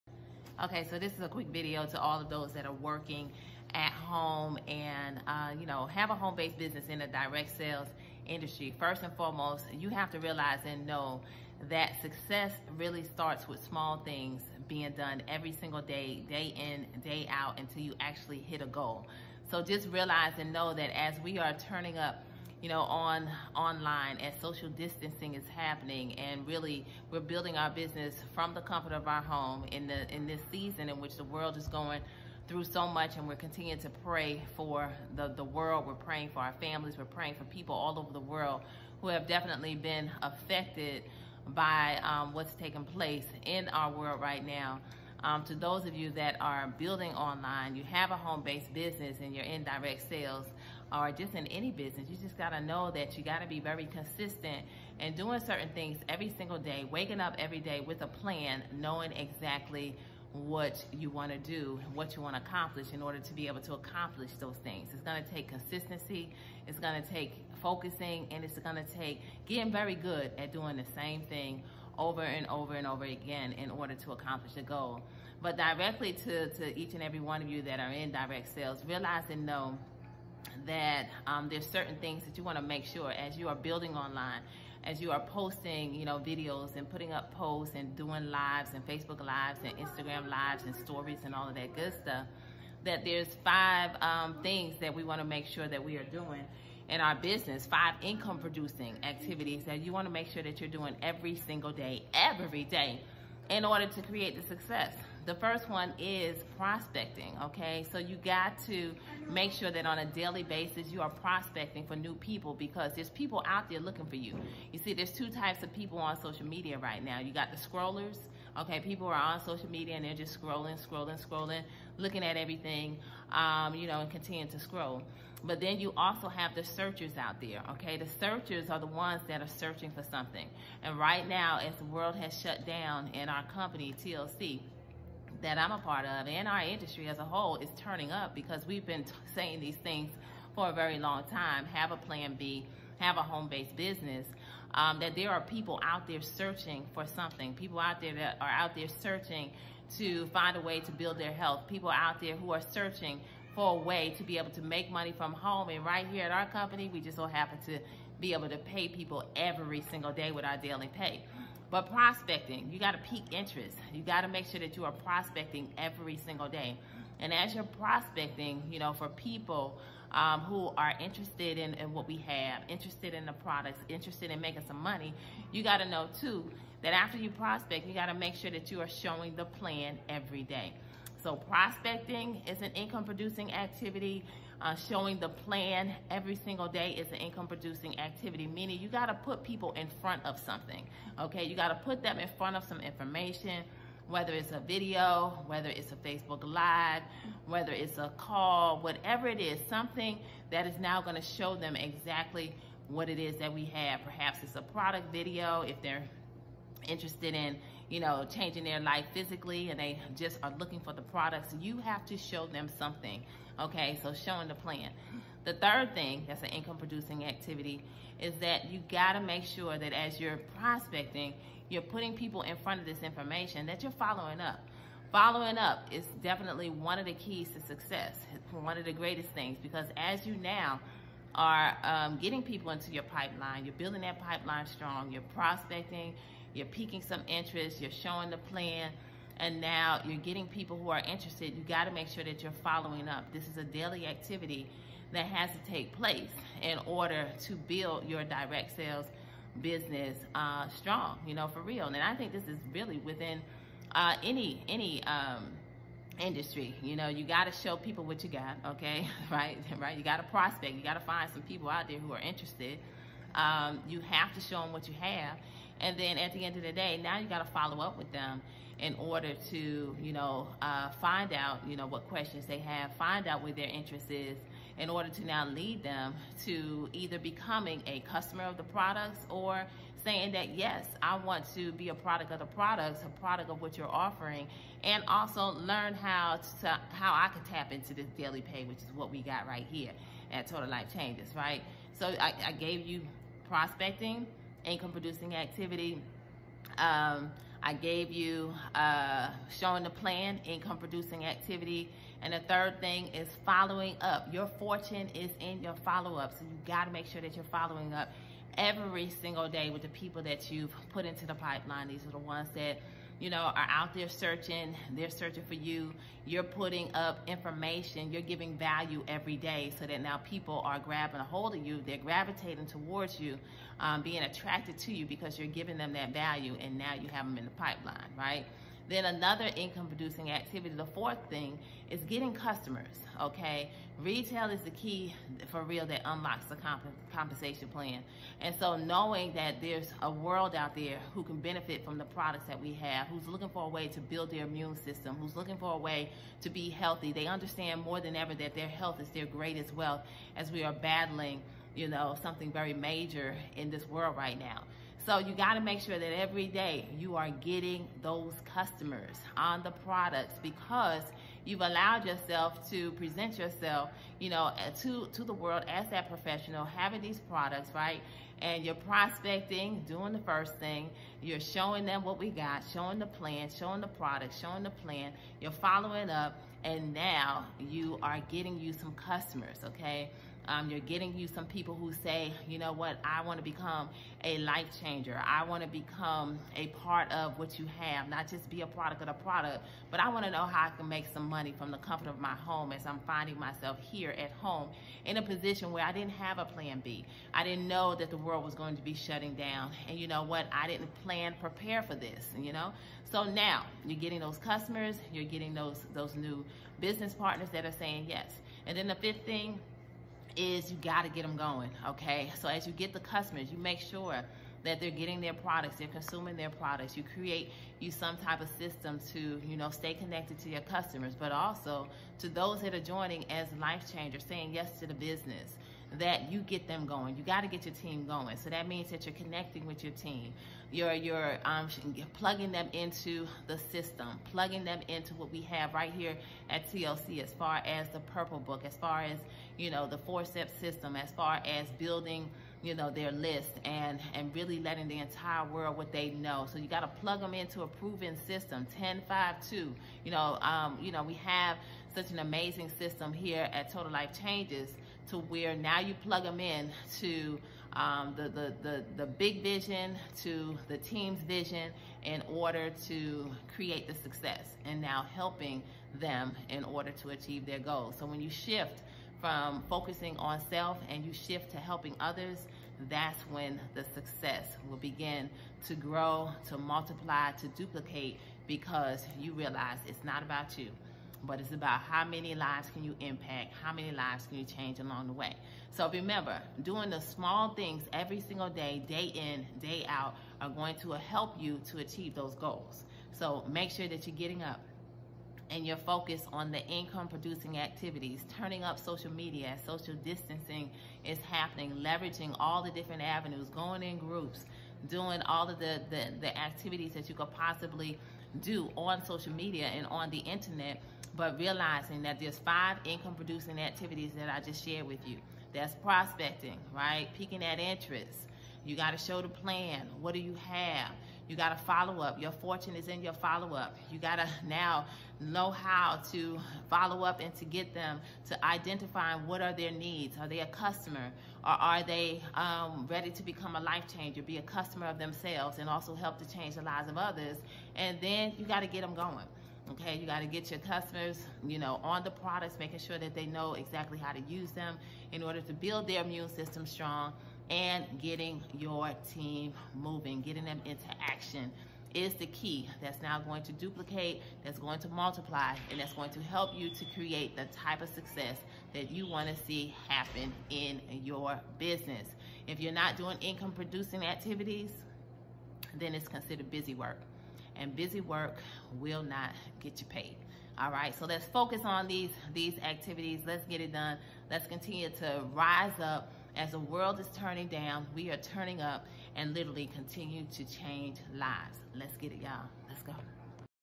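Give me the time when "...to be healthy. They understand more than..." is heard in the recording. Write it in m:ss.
5:46.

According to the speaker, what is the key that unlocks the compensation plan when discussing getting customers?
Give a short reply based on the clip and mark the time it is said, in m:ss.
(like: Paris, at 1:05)
Retail, at 5:34.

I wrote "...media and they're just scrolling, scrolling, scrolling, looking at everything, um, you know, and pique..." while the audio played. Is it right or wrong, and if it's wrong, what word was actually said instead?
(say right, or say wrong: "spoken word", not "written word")
wrong: "continue", not "pique".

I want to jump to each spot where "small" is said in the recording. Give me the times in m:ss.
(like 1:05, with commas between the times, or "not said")
0:13, 8:06.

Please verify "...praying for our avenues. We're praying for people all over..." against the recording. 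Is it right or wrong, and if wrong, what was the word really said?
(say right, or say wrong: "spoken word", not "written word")
wrong: "families", not "avenues".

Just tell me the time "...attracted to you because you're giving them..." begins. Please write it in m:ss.
5:24.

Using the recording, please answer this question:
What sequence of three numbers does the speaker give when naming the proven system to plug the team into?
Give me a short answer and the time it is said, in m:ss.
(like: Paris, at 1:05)
10, 5, 2, at 7:28.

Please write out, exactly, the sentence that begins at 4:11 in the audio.
And I think this is really within uh, any, any, um, industry.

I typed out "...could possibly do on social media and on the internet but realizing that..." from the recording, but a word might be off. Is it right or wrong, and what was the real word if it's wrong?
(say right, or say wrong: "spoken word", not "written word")
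right.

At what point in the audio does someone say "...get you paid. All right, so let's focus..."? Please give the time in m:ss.
9:29.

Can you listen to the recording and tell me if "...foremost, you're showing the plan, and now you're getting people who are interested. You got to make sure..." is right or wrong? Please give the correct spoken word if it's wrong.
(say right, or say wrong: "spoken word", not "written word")
wrong: "interest", not "foremost".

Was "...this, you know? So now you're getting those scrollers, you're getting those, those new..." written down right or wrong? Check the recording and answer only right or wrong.
wrong.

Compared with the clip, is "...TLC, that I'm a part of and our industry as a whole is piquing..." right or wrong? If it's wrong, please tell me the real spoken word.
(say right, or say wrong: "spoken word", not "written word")
wrong: "turning", not "piquing".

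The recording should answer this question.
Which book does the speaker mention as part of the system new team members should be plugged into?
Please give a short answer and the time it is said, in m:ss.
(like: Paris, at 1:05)
Purple Book, at 7:17.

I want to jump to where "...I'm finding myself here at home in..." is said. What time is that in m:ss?
6:32.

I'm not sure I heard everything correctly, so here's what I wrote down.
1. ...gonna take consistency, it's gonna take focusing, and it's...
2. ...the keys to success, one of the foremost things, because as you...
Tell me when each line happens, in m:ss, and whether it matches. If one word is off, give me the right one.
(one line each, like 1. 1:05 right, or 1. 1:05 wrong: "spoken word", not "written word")
1. 1:05 right
2. 3:47 wrong: "greatest", not "foremost".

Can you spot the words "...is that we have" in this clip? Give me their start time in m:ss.
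3:23.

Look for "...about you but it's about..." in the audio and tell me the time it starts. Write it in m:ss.
8:00.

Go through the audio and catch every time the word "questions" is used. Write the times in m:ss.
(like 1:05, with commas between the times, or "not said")
4:32.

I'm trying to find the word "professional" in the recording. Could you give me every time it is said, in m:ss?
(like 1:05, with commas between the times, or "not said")
6:06.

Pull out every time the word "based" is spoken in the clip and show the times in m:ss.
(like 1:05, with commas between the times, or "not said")
0:06, 0:48, 2:23.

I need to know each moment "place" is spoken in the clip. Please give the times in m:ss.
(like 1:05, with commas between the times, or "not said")
0:42, 4:05.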